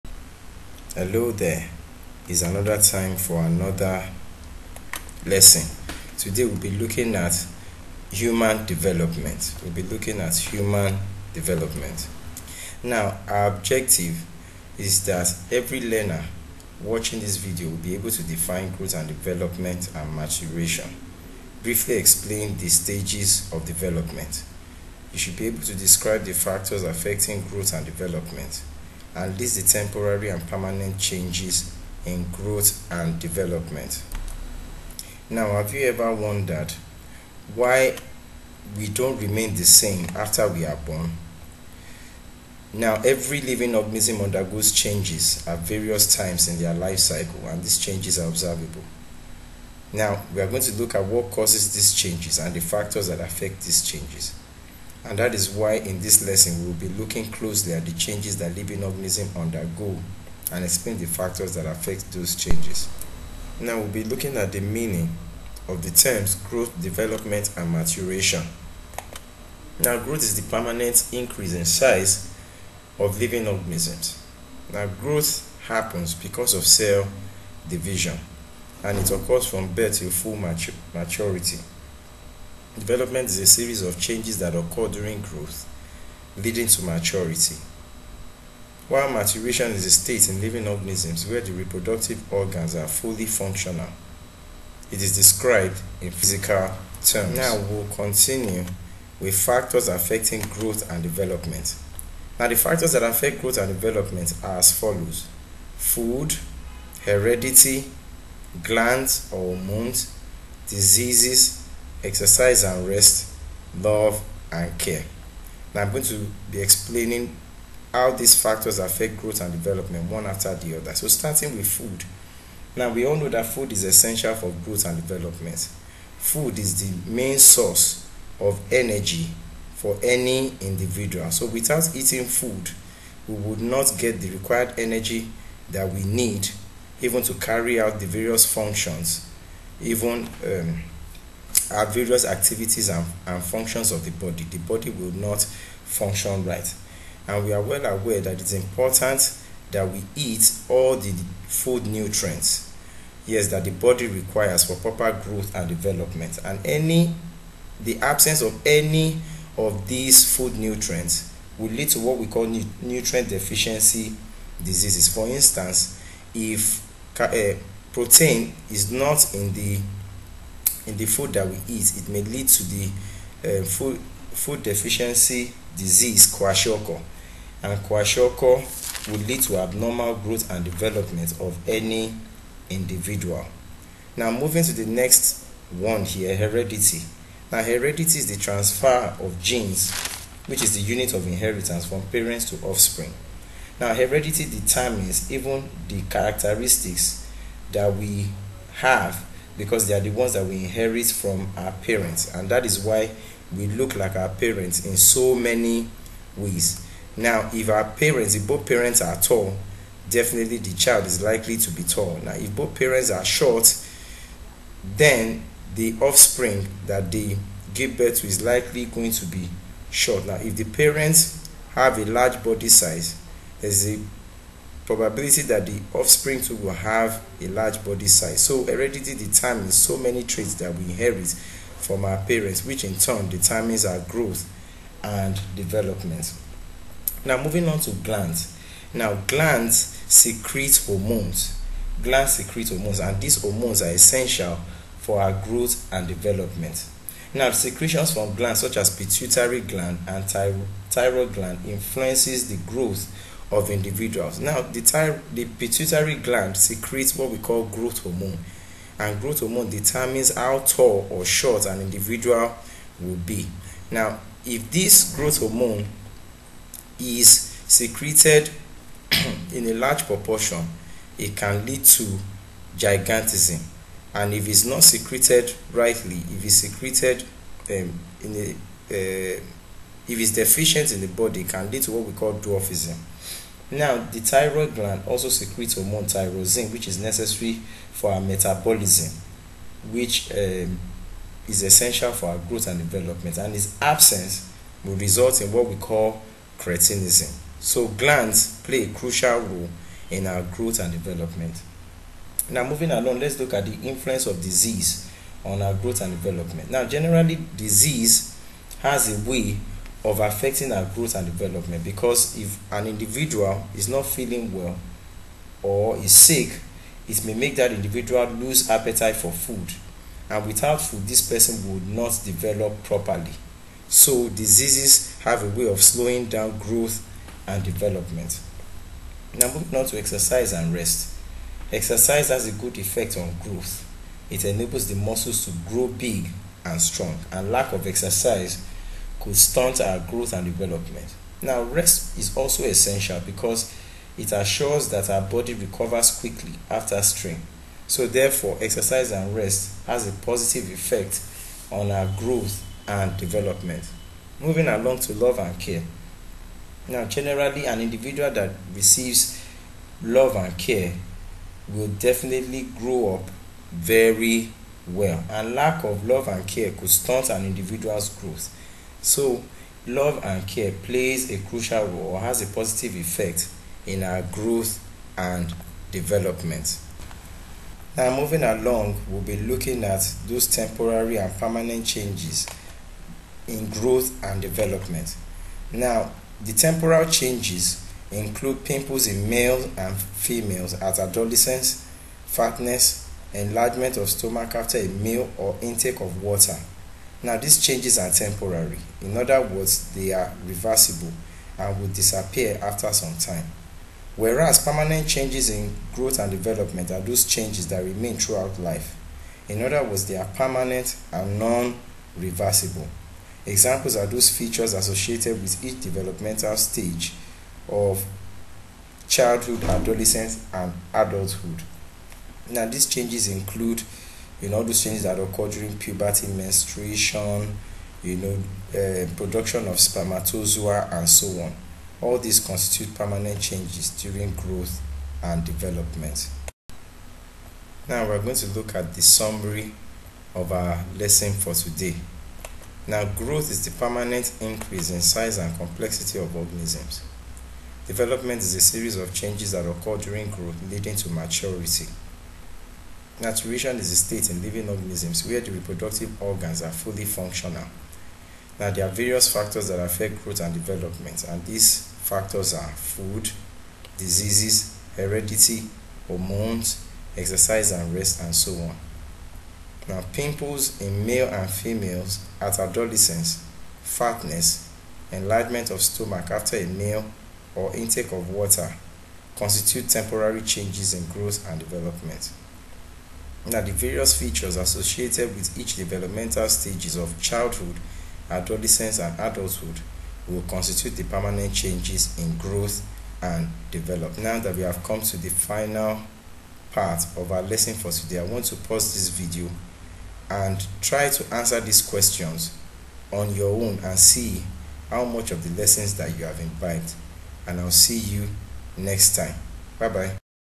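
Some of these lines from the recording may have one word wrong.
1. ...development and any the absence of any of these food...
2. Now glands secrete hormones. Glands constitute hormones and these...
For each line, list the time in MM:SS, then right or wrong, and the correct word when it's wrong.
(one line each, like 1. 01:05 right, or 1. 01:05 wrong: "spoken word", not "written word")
1. 02:35 right
2. 03:58 wrong: "secrete", not "constitute".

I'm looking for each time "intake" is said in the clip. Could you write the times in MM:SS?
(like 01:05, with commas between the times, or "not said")
06:35, 07:57.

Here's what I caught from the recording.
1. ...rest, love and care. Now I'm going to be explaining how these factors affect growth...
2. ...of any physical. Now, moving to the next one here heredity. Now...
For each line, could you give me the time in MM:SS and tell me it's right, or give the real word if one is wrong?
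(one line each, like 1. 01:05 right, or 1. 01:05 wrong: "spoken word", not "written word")
1. 01:52 right
2. 03:01 wrong: "individual", not "physical".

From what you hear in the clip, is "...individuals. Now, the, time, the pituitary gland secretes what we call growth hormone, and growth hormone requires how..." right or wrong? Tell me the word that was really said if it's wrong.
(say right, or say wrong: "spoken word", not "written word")
wrong: "determines", not "requires".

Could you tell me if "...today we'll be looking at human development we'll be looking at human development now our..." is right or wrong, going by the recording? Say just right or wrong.
right.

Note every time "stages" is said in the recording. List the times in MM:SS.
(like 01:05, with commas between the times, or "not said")
00:22, 06:56, 08:06.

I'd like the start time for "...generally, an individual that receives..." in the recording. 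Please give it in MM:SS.
05:57.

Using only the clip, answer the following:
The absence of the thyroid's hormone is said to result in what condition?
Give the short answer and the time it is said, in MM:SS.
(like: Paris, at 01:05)
Cretinism, at 04:56.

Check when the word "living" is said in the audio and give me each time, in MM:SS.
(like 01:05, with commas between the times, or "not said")
00:43, 00:58, 01:13, 01:30, 07:34.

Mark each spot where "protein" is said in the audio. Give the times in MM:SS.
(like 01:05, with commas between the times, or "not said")
02:47.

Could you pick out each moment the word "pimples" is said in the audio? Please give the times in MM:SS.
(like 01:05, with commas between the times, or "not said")
06:28, 07:50.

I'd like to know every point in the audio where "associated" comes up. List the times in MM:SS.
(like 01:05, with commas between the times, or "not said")
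06:54, 08:04.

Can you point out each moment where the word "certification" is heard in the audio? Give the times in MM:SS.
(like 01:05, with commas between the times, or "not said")
not said.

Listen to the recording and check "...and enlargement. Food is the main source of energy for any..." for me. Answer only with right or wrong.
wrong.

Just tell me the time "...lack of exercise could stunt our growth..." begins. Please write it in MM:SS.
05:37.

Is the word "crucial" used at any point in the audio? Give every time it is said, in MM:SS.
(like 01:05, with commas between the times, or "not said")
04:58, 06:11.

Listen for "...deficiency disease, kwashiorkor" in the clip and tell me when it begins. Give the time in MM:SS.
02:54.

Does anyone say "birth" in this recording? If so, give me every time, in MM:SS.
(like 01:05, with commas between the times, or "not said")
01:19, 03:37.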